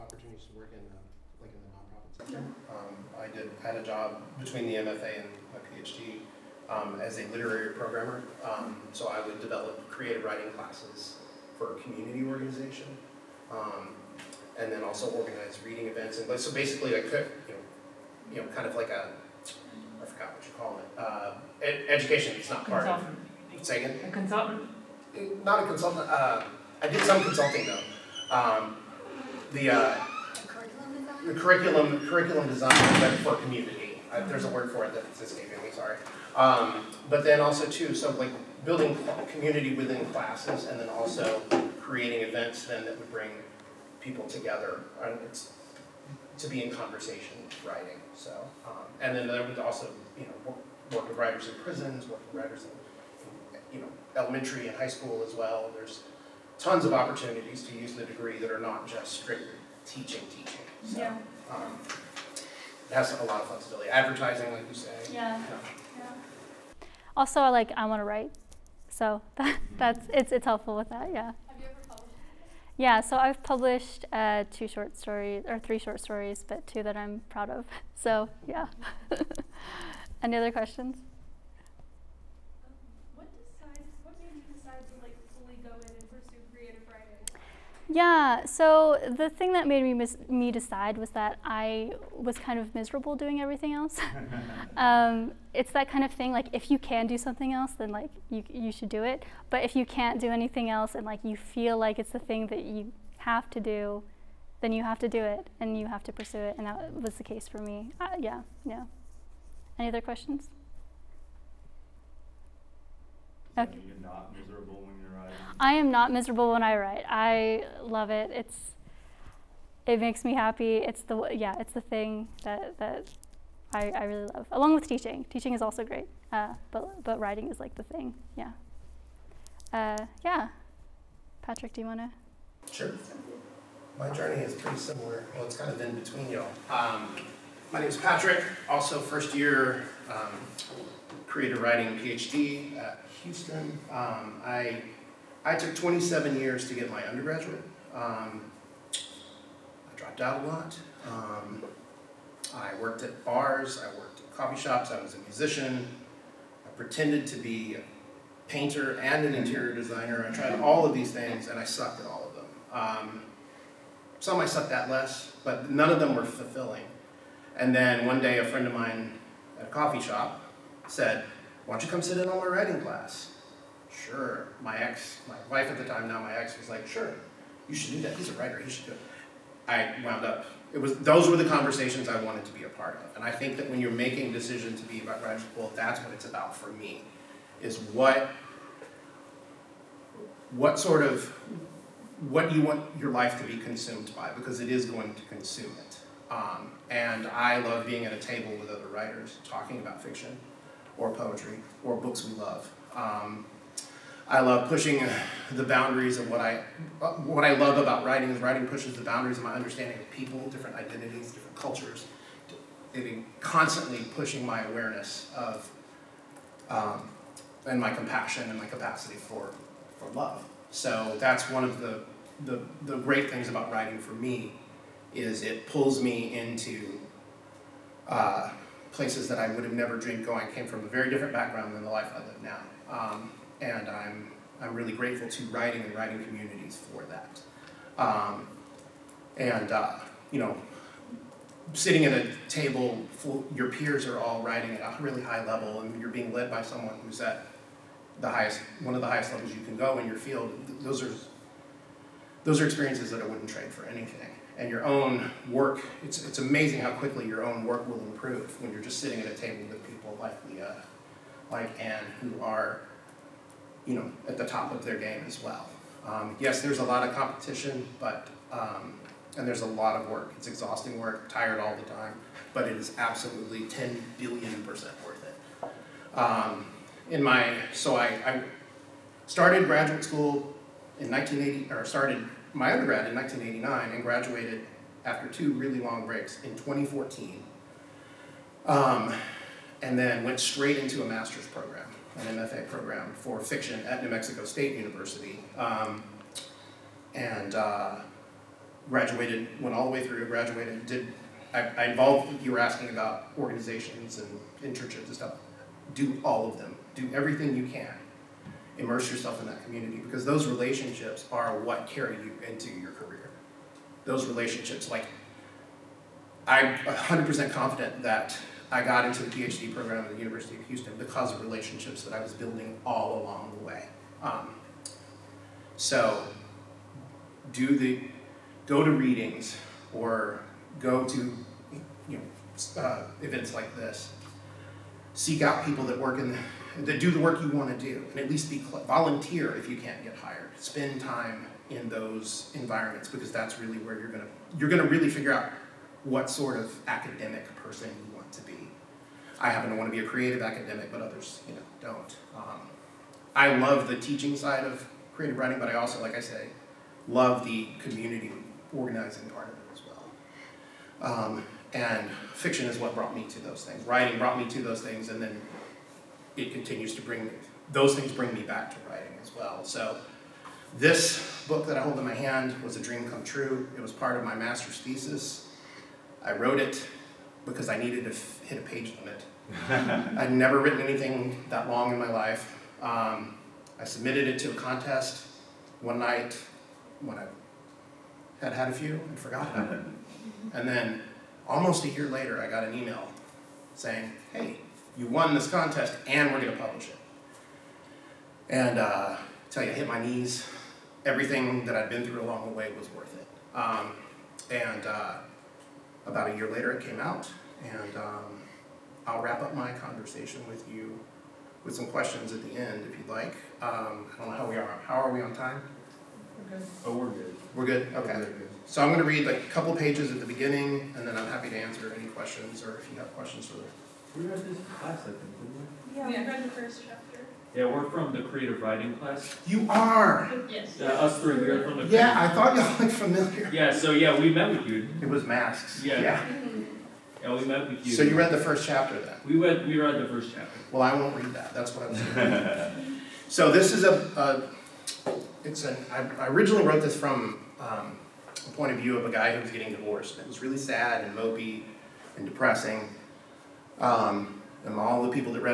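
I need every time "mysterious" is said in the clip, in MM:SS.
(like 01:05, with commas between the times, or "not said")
not said.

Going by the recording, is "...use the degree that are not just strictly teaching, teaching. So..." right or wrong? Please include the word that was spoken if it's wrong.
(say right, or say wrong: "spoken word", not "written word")
right.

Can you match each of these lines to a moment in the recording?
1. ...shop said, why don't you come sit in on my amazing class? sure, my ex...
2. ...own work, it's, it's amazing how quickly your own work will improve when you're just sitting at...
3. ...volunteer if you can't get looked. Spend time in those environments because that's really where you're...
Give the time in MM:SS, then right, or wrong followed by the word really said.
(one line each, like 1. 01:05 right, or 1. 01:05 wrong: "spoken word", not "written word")
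1. 02:50 wrong: "writing", not "amazing"
2. 04:14 right
3. 05:38 wrong: "hired", not "looked".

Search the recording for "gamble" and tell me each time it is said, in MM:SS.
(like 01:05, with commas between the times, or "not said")
not said.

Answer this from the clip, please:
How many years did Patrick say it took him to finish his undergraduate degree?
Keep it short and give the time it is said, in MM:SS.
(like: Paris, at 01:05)
27, at 02:25.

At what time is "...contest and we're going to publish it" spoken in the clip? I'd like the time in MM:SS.
06:35.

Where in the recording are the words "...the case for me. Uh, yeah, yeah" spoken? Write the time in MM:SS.
01:47.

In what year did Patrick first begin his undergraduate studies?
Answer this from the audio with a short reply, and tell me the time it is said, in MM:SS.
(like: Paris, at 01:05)
1989, at 04:43.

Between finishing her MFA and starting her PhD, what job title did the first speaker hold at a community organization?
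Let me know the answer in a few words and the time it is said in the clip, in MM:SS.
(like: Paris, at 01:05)
Literary programmer, at 00:07.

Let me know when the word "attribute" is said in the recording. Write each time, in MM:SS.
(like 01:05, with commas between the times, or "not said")
not said.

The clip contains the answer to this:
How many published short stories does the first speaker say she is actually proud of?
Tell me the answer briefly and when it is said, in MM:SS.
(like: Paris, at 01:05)
2, at 01:16.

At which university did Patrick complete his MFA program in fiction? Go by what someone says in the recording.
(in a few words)
New Mexico State University.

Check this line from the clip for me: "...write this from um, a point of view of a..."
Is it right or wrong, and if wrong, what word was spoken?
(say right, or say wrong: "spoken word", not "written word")
wrong: "wrote", not "write".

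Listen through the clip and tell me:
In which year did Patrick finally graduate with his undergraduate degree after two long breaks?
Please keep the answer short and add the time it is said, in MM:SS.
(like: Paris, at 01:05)
2014, at 04:46.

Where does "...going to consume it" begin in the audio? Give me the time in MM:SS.
03:14.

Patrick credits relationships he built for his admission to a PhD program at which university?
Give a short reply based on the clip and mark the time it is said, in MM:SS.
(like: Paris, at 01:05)
University of Houston, at 05:20.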